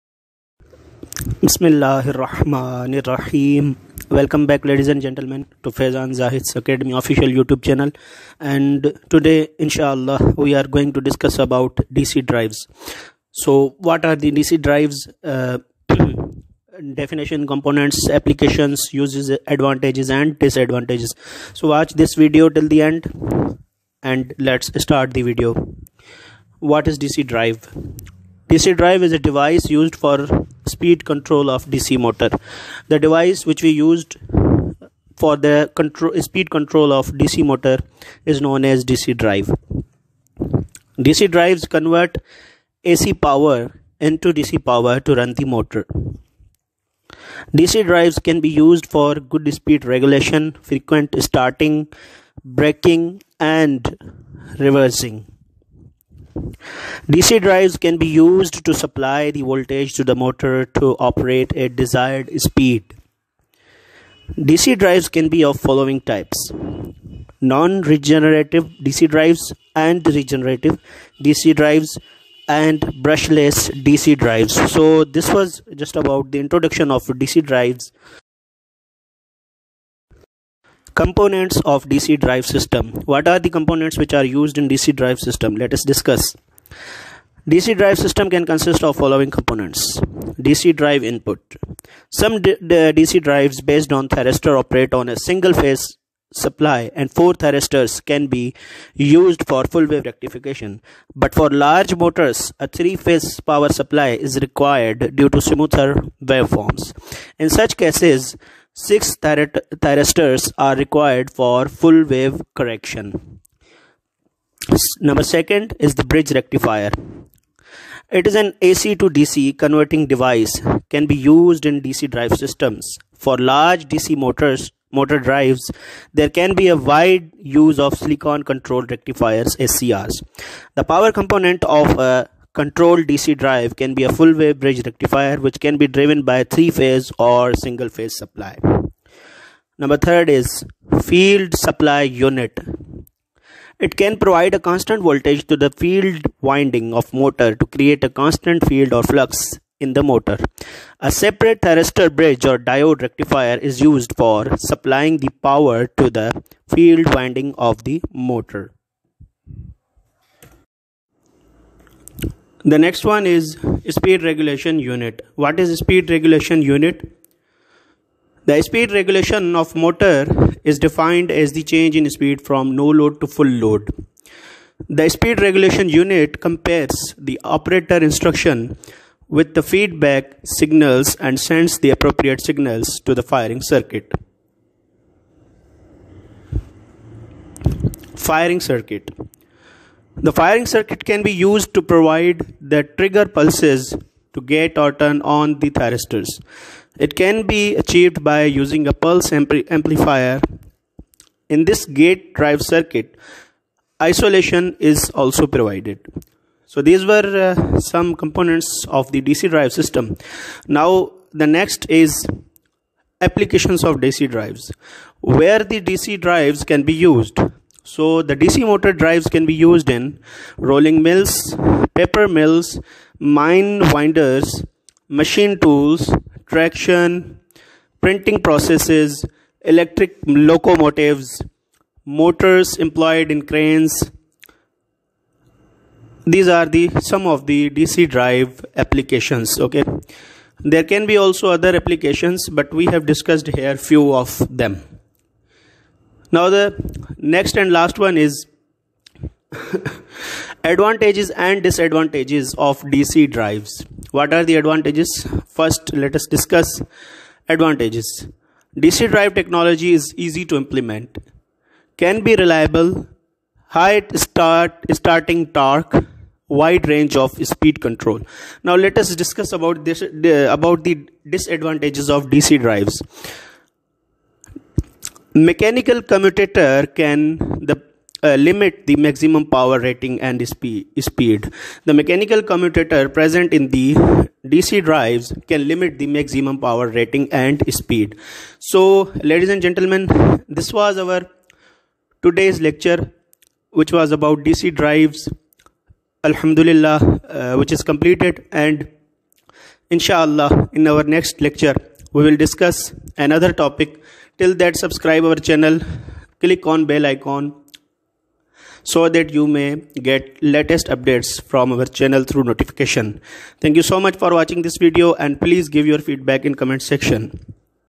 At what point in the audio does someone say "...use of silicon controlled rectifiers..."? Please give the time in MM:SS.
02:07.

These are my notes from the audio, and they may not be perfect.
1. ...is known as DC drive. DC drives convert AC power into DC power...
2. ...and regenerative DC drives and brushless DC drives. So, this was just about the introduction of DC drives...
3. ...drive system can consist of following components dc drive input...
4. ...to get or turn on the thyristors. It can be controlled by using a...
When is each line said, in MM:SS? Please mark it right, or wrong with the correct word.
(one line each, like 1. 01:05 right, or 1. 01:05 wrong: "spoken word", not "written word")
1. 00:38 right
2. 01:09 right
3. 01:27 right
4. 03:14 wrong: "achieved", not "controlled".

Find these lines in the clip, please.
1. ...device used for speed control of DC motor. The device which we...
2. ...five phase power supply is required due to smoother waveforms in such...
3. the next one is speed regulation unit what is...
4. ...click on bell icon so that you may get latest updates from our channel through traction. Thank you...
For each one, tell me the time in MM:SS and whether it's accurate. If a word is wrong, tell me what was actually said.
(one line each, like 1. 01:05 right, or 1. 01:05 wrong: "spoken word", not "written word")
1. 00:29 right
2. 01:42 wrong: "three", not "five"
3. 02:42 right
4. 05:06 wrong: "notification", not "traction".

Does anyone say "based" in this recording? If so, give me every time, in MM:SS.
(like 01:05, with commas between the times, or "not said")
01:33.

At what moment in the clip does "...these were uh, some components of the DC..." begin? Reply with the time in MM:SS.
03:26.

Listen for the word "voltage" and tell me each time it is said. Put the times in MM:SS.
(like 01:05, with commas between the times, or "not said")
00:59, 02:25.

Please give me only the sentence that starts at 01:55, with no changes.
Number second is the bridge rectifier.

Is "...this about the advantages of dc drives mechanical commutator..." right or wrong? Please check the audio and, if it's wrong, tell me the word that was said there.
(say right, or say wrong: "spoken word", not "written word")
wrong: "disadvantages", not "advantages".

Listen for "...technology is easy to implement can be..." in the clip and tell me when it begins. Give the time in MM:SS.
04:19.